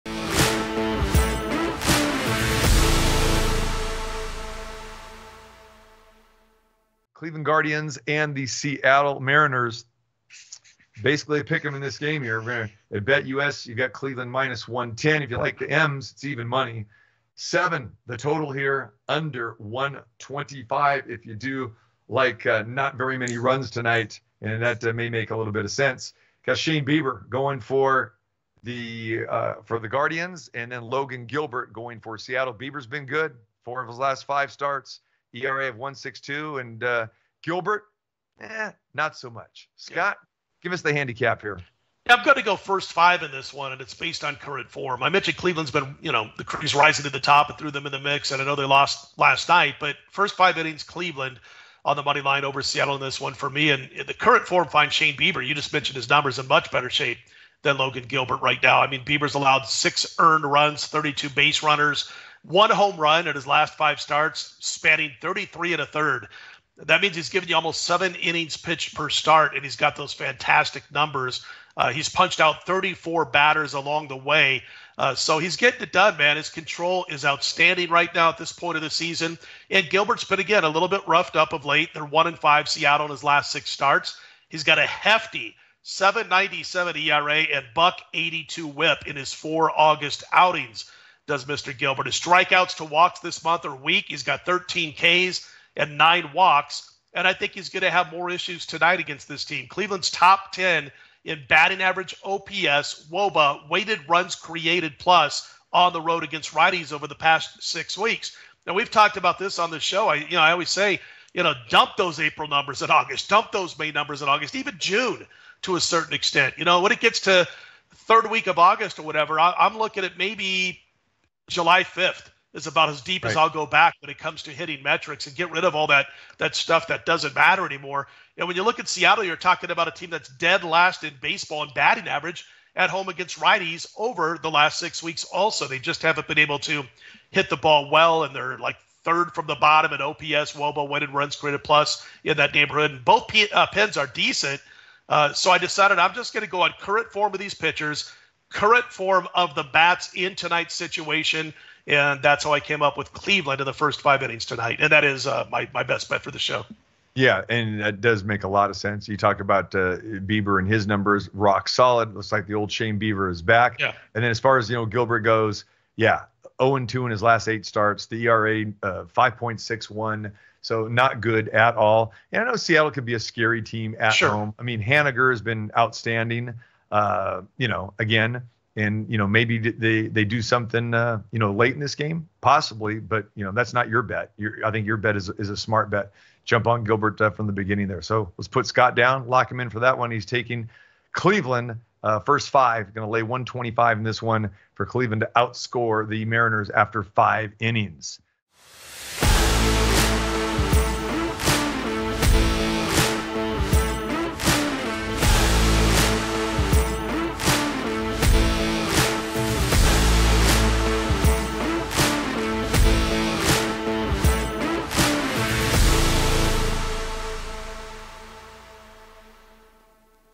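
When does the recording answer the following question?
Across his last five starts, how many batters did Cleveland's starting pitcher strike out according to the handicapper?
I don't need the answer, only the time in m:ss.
1:12.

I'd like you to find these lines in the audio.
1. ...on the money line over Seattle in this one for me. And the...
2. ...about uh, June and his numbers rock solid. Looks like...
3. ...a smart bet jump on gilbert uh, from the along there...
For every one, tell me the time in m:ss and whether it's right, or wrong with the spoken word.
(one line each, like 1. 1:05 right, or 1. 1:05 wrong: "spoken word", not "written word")
1. 0:51 right
2. 2:39 wrong: "Bieber", not "June"
3. 3:05 wrong: "beginning", not "along".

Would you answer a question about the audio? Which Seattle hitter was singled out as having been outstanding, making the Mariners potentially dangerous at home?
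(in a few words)
Haniger.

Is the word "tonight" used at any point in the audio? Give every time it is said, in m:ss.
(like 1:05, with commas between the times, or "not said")
0:23, 1:38, 2:30, 2:34.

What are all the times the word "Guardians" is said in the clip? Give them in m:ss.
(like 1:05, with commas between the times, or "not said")
0:07, 0:29.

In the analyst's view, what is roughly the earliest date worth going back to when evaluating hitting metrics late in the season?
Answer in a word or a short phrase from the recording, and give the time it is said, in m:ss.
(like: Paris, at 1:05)
July 5th, at 2:01.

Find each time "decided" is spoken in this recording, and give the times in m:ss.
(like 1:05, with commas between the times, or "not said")
2:25.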